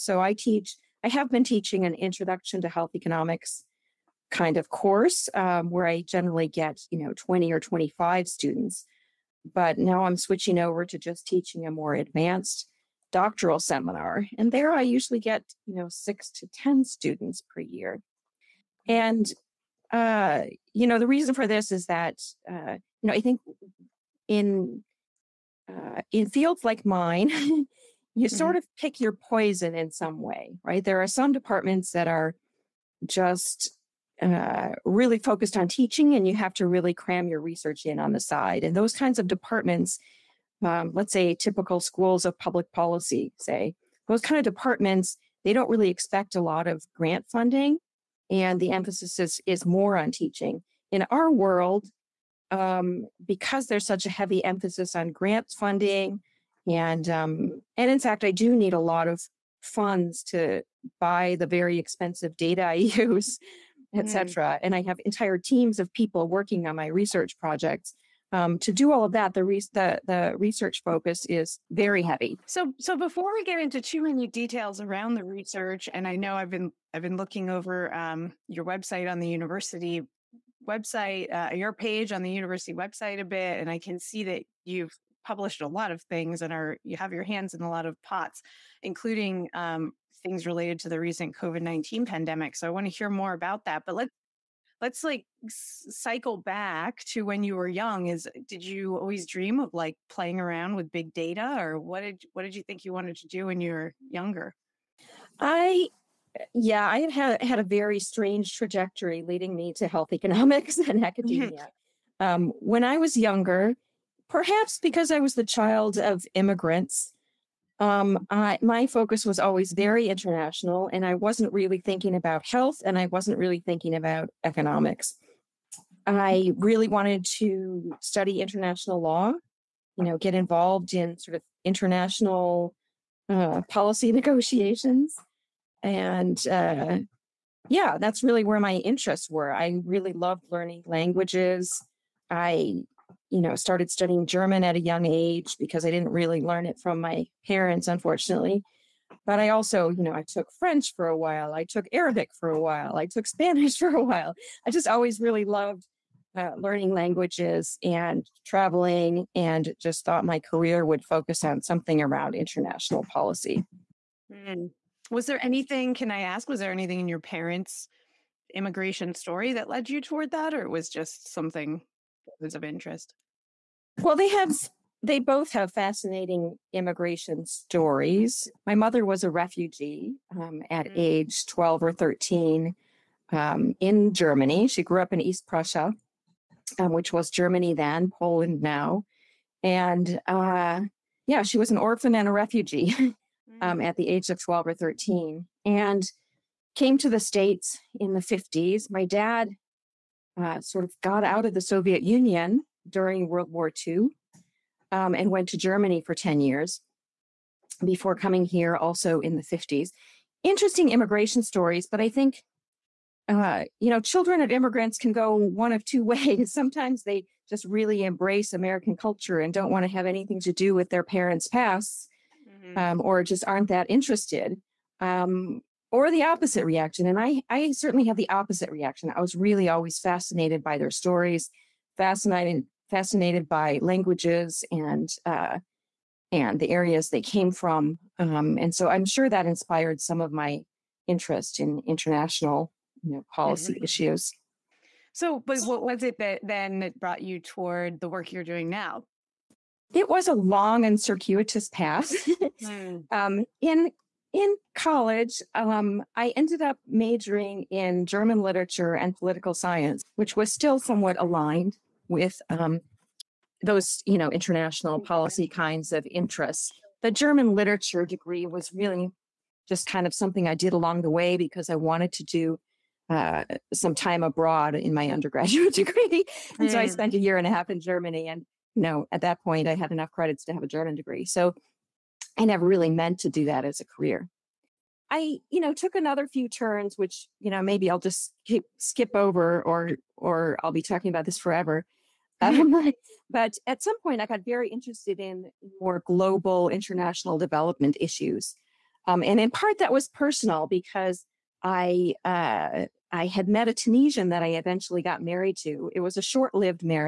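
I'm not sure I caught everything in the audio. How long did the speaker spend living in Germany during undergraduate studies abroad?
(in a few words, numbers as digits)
A year and a half.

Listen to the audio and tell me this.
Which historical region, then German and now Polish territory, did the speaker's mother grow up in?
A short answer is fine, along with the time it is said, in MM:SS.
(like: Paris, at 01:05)
East Prussia, at 03:05.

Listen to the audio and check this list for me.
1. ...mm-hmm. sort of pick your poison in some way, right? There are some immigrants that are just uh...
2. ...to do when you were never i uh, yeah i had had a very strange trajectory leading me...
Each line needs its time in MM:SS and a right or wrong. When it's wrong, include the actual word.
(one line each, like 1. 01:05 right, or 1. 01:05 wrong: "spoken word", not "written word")
1. 00:28 wrong: "departments", not "immigrants"
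2. 01:43 wrong: "younger", not "never".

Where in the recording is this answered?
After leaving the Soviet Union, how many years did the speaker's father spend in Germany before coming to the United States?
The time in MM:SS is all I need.
03:26.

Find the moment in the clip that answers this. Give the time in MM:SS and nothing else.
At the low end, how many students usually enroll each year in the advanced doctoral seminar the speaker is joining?
00:15.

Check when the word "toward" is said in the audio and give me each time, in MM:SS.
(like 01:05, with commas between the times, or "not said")
02:50, 04:07.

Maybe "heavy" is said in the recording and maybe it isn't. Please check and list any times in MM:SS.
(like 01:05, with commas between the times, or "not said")
00:54, 01:12.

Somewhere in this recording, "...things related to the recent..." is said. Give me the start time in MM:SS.
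01:30.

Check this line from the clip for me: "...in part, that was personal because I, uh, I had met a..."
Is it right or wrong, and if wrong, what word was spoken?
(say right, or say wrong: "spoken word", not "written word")
right.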